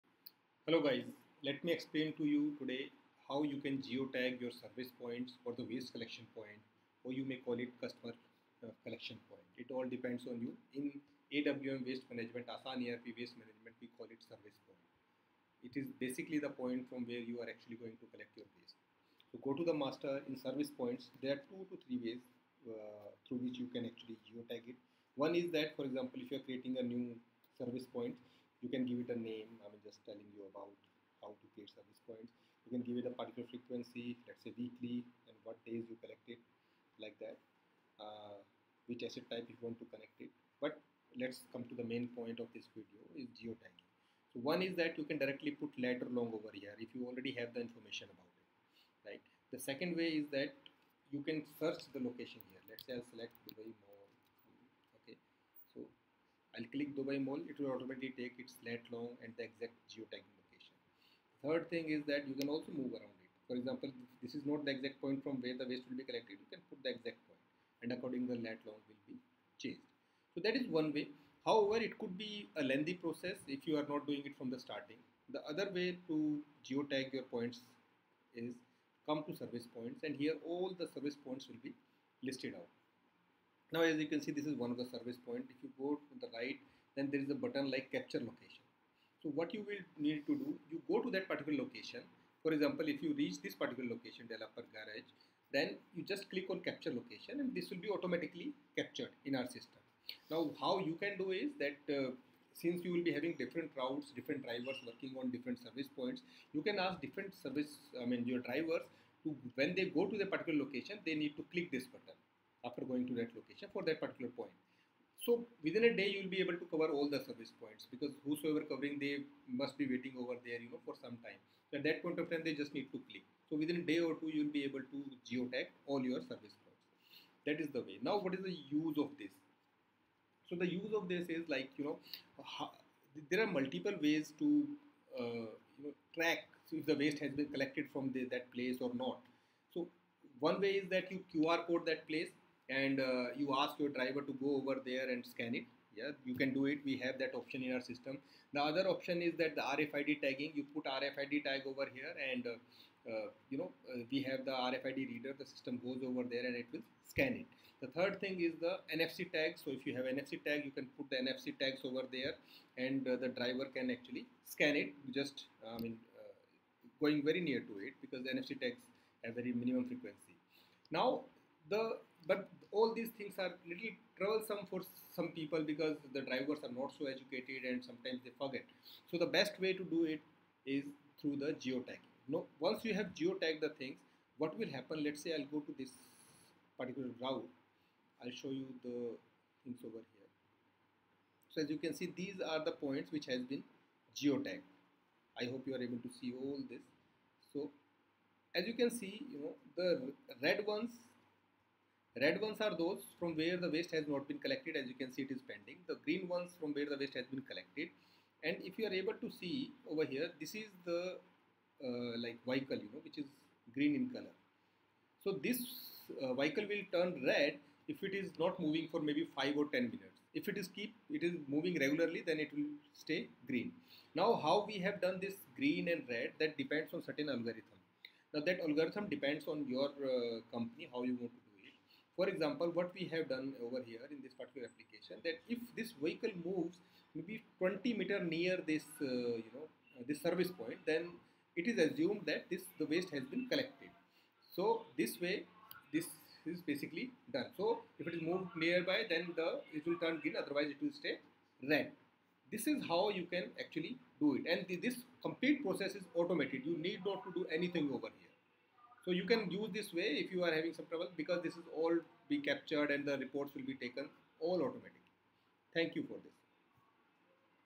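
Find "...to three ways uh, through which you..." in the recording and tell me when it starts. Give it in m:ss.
0:21.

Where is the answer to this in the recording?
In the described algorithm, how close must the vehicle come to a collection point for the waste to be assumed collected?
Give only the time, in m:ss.
3:57.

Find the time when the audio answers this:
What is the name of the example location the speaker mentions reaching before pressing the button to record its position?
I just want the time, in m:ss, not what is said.
1:34.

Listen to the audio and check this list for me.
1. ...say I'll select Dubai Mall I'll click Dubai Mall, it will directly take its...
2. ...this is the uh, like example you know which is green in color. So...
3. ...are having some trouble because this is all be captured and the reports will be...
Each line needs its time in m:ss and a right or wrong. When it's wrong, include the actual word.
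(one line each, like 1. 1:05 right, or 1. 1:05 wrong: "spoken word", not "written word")
1. 0:52 wrong: "automatically", not "directly"
2. 3:30 wrong: "vehicle", not "example"
3. 4:20 right.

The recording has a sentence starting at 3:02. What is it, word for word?
No, once you have geotagged the things, what will happen?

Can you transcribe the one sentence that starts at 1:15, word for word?
The other way to geotag your points is come to service points and here all the service points will be listed out.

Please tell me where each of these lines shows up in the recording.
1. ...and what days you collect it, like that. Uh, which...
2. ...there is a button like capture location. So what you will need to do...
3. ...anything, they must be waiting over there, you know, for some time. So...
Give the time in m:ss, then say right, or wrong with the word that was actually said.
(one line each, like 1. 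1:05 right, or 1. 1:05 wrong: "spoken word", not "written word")
1. 0:35 right
2. 1:27 right
3. 1:58 wrong: "covering", not "anything".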